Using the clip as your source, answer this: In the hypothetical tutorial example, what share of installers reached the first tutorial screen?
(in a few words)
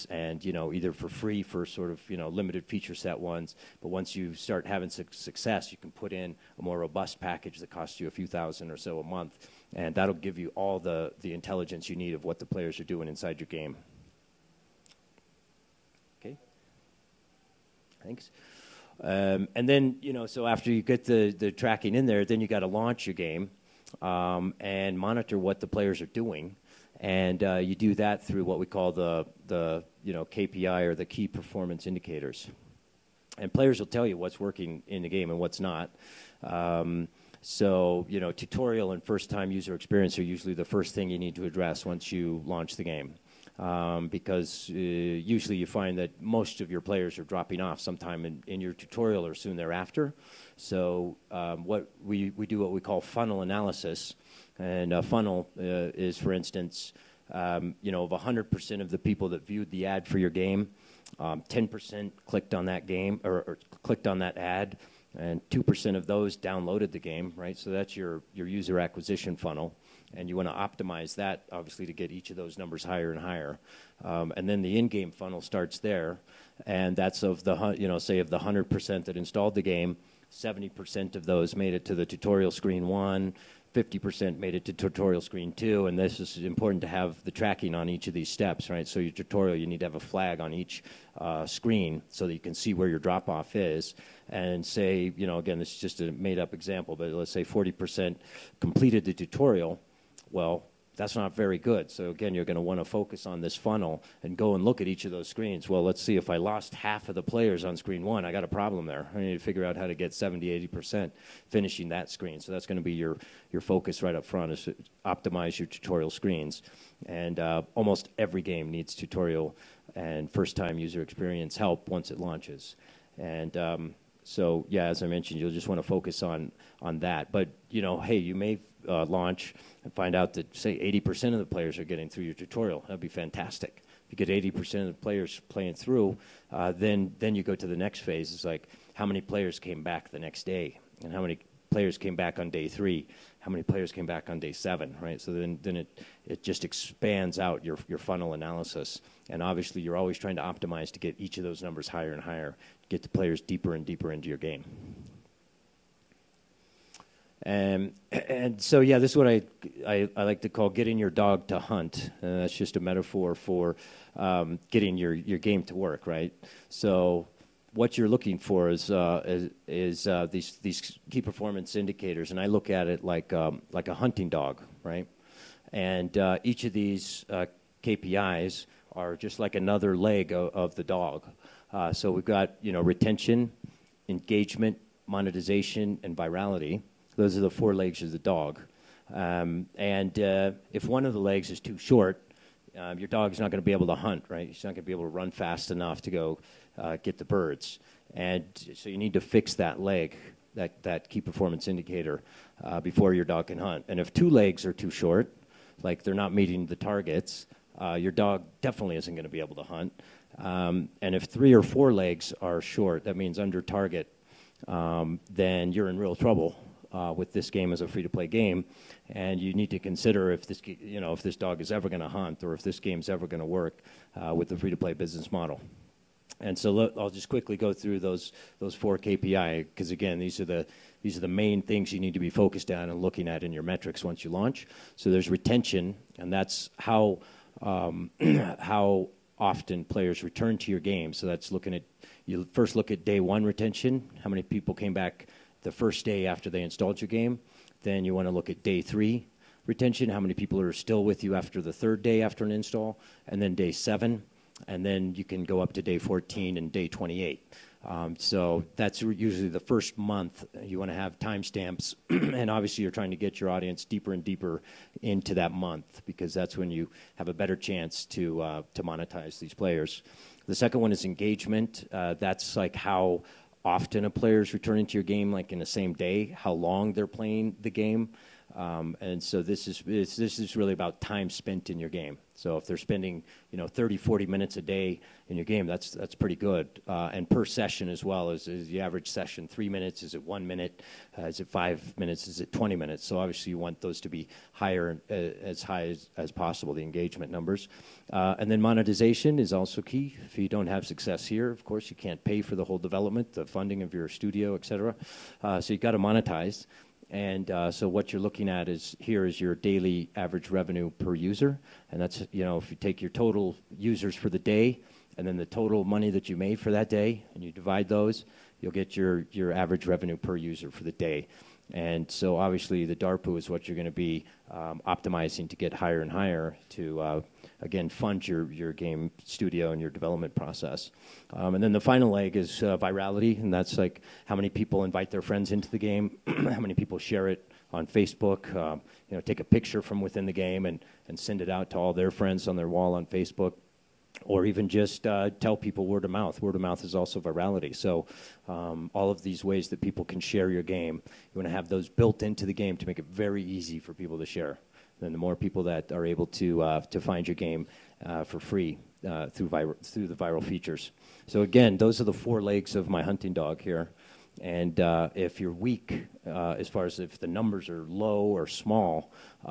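70%.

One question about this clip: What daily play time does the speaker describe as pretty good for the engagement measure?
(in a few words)
30 to 40 minutes.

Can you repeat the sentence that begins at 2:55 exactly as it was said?
And uh, each of these uh, KPIs are just like another leg of, of the dog.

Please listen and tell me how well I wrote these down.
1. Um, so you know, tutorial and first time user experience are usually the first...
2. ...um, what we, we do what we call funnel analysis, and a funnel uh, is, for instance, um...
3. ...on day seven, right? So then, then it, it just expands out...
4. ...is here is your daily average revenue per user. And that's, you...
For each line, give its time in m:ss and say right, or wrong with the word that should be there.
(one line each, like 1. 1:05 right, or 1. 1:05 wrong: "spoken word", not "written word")
1. 0:36 right
2. 0:51 right
3. 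2:24 right
4. 5:08 right.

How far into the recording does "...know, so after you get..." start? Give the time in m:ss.
0:20.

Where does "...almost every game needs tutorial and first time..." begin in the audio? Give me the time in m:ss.
1:57.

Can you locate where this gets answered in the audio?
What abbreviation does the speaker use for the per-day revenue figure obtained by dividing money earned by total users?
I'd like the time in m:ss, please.
5:22.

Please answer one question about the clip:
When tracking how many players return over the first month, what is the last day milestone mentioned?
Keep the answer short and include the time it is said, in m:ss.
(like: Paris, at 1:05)
day 28, at 4:16.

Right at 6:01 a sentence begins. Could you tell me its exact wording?
So again, those are the four legs of my hunting dog here.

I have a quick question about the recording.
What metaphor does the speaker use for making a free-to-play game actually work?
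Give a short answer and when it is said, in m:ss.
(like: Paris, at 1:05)
getting your dog to hunt, at 2:40.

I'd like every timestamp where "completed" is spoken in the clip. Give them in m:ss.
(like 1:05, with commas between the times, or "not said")
1:38.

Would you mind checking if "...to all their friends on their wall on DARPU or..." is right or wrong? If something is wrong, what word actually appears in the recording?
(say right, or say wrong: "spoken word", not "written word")
wrong: "Facebook", not "DARPU".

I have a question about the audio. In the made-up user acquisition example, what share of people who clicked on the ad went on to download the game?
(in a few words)
2%.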